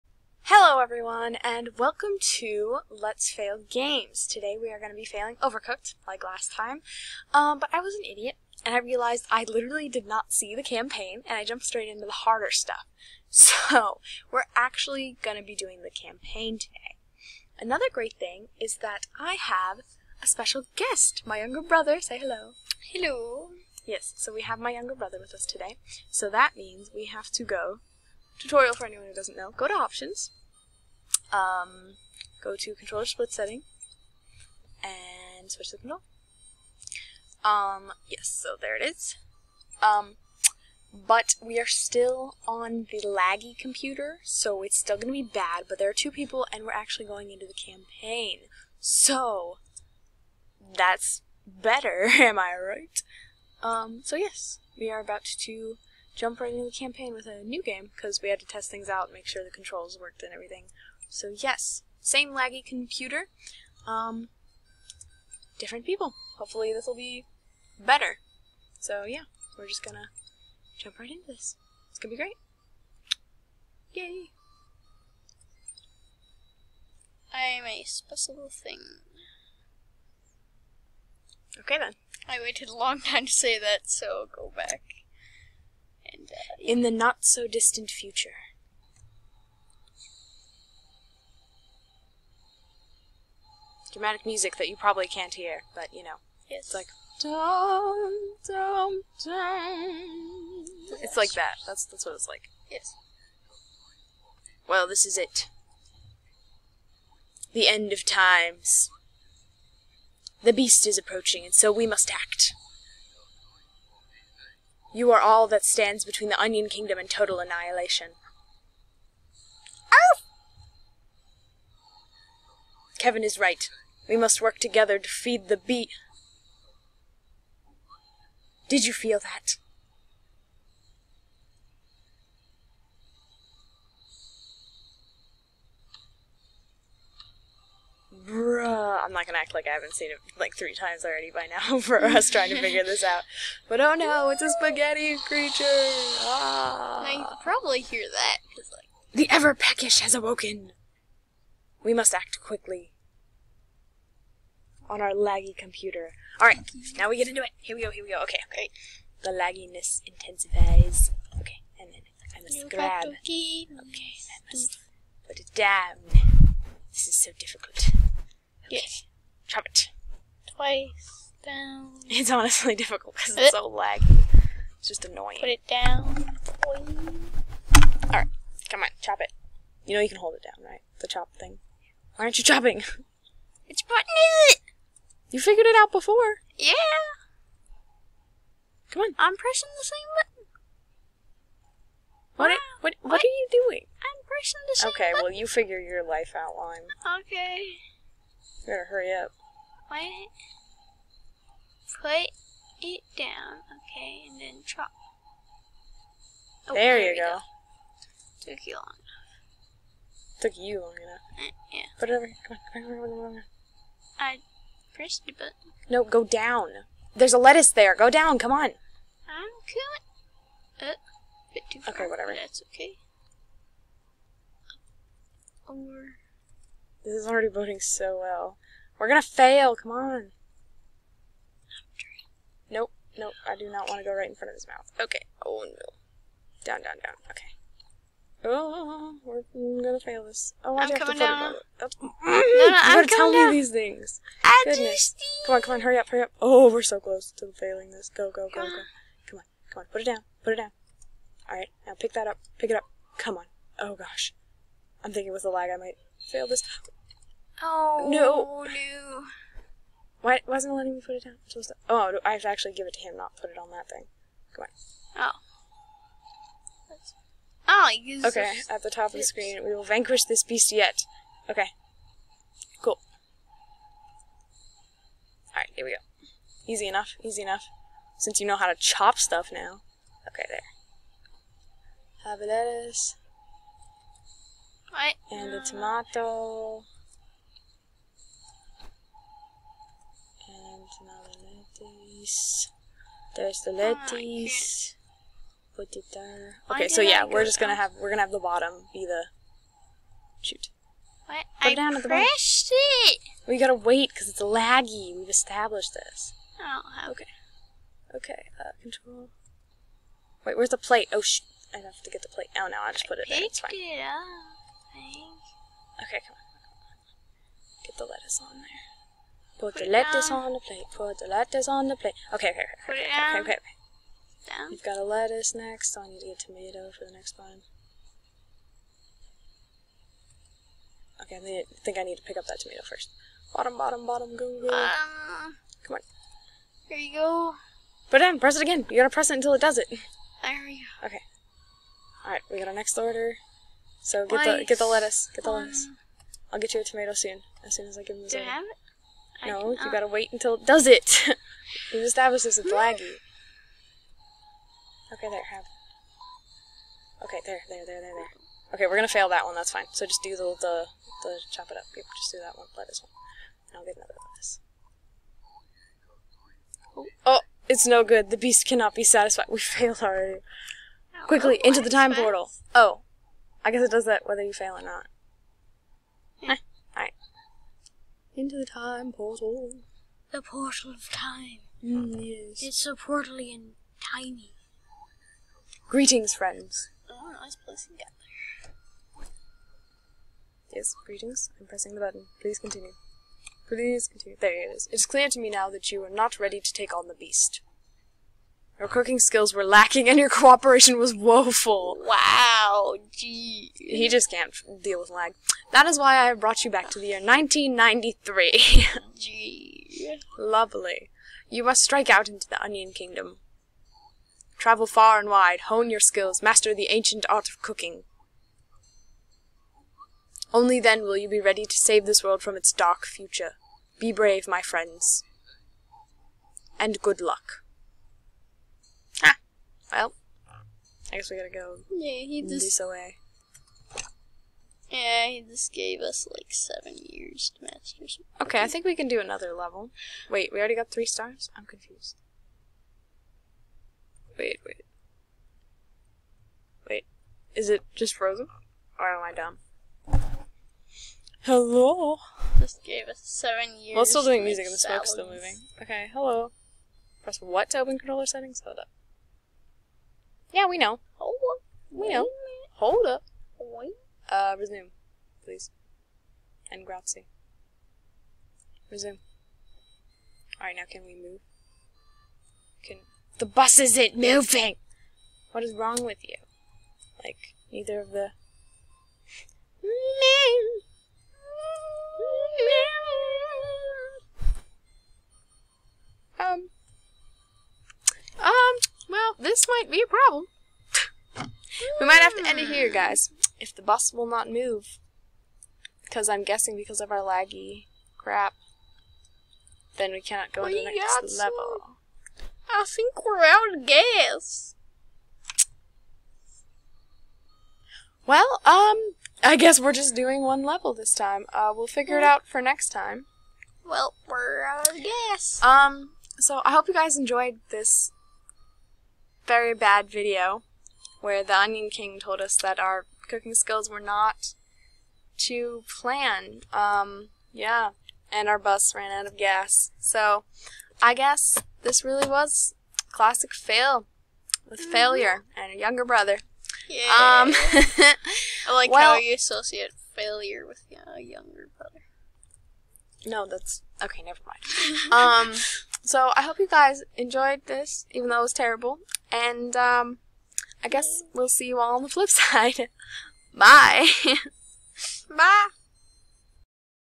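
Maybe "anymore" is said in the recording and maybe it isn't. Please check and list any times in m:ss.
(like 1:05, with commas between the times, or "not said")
not said.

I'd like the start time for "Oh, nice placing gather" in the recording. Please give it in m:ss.
6:27.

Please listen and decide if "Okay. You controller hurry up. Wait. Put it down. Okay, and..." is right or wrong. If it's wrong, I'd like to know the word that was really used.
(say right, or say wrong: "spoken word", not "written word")
wrong: "better", not "controller".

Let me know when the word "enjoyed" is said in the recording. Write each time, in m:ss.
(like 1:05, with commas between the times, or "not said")
8:37, 9:07.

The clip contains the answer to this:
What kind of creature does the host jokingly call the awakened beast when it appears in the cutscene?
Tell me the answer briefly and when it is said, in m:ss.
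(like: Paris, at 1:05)
spaghetti creature, at 2:24.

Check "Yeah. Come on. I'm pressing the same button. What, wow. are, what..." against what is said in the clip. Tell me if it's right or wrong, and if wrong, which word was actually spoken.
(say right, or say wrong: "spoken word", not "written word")
right.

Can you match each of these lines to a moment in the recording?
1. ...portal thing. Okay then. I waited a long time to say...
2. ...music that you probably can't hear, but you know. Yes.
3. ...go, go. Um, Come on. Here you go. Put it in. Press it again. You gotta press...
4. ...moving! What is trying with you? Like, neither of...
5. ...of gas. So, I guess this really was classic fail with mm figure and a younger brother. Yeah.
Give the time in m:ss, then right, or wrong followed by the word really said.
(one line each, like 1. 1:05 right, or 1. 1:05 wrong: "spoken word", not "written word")
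1. 1:17 wrong: "special", not "portal"
2. 1:34 right
3. 5:34 right
4. 7:54 wrong: "wrong", not "trying"
5. 8:49 wrong: "failure", not "figure".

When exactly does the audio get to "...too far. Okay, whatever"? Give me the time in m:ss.
3:41.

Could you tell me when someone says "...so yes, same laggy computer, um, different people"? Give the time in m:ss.
1:01.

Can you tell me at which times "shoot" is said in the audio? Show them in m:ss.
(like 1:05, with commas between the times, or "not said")
5:00.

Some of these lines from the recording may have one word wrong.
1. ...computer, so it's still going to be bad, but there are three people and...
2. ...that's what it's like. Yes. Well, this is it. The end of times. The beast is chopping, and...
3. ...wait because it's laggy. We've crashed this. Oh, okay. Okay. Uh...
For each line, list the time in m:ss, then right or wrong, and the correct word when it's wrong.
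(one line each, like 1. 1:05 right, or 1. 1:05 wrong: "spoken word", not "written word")
1. 0:43 wrong: "two", not "three"
2. 1:41 wrong: "approaching", not "chopping"
3. 5:03 wrong: "established", not "crashed".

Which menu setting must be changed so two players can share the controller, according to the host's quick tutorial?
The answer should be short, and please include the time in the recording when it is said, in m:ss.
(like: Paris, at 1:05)
controller split setting, at 0:32.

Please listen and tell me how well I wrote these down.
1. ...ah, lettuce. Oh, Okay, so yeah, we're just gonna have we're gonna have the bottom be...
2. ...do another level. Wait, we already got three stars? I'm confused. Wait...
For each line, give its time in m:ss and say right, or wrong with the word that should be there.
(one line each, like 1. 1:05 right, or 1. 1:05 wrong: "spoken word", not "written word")
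1. 4:53 right
2. 7:19 right.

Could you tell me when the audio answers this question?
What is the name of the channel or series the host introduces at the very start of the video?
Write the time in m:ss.
0:02.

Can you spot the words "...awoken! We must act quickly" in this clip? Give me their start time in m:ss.
2:30.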